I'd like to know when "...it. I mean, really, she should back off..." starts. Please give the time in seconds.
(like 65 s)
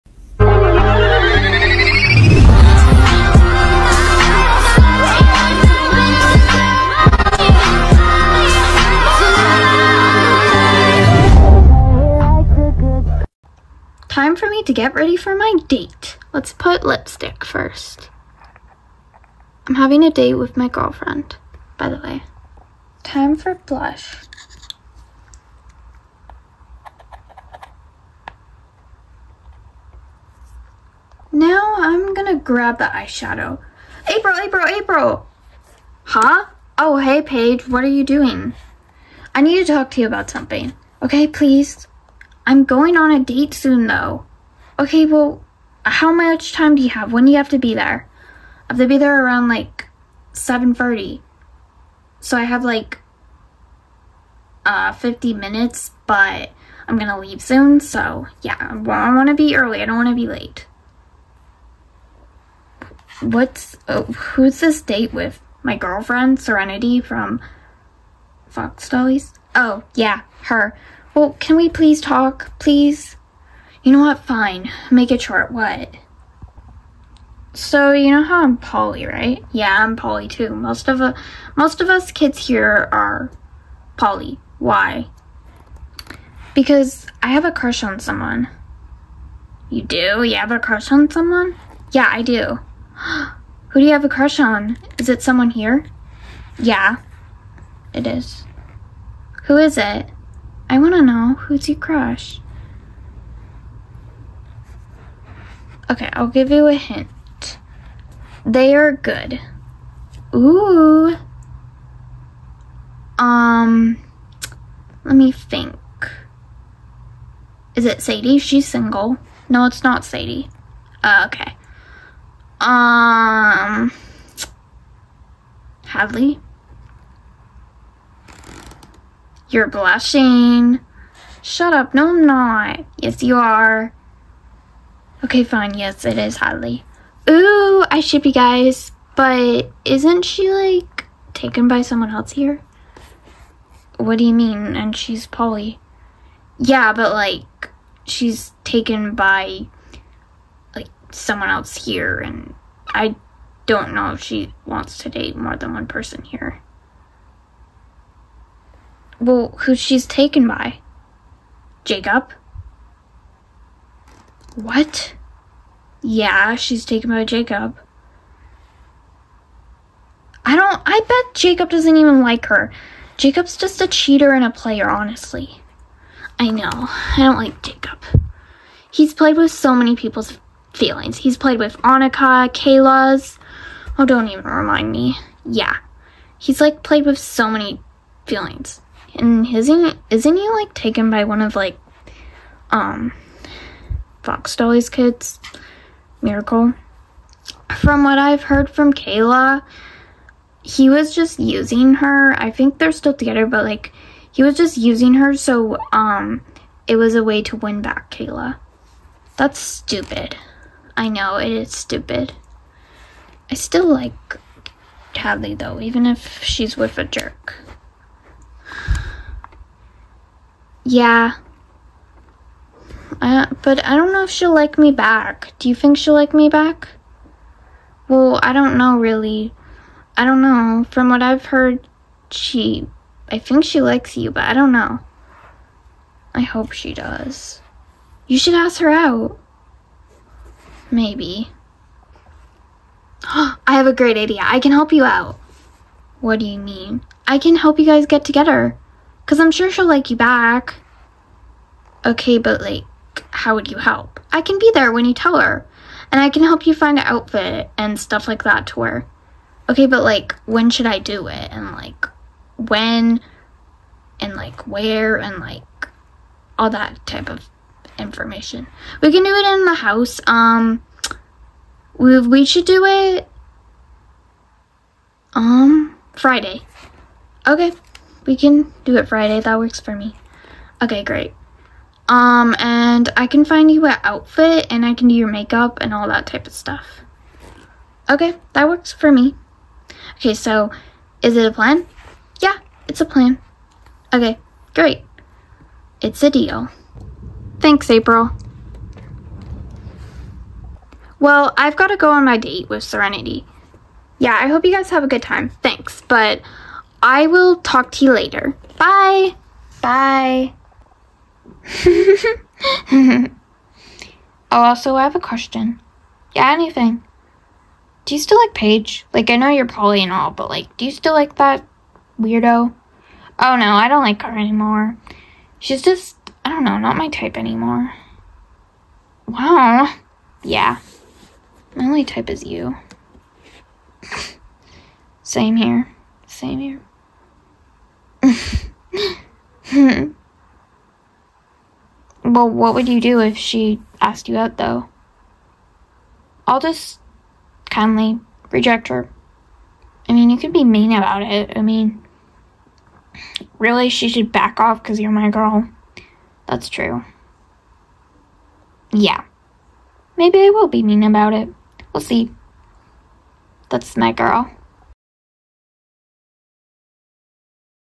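351 s.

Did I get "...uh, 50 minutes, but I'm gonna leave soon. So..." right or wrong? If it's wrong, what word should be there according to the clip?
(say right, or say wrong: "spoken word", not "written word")
right.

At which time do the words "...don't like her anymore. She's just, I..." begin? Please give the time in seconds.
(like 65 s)
323 s.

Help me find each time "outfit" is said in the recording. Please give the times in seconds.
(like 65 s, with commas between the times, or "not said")
257 s, 284 s.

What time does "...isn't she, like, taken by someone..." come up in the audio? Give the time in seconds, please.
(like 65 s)
139 s.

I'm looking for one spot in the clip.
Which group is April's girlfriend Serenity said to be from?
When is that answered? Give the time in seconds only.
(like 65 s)
68 s.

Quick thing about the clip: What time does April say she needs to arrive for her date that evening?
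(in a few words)
7:30.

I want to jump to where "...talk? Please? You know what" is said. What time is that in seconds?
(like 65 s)
71 s.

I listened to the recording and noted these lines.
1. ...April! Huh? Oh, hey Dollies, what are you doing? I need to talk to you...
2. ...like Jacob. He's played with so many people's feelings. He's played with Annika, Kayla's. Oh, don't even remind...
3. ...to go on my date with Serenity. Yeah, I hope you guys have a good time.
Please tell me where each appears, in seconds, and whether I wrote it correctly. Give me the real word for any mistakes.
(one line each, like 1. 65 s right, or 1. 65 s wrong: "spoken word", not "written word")
1. 34 s wrong: "Paige", not "Dollies"
2. 177 s right
3. 301 s right.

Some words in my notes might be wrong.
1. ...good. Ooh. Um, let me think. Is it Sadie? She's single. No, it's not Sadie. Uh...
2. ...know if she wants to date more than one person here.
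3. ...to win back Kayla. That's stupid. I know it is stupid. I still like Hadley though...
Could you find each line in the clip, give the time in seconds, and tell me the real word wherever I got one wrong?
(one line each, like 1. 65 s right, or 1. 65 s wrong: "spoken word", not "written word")
1. 108 s right
2. 153 s right
3. 207 s right.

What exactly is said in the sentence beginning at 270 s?
Um, we, we should do it, um, Friday.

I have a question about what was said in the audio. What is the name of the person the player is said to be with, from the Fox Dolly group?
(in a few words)
Miracle.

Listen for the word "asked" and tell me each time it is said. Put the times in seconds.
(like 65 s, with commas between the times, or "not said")
343 s.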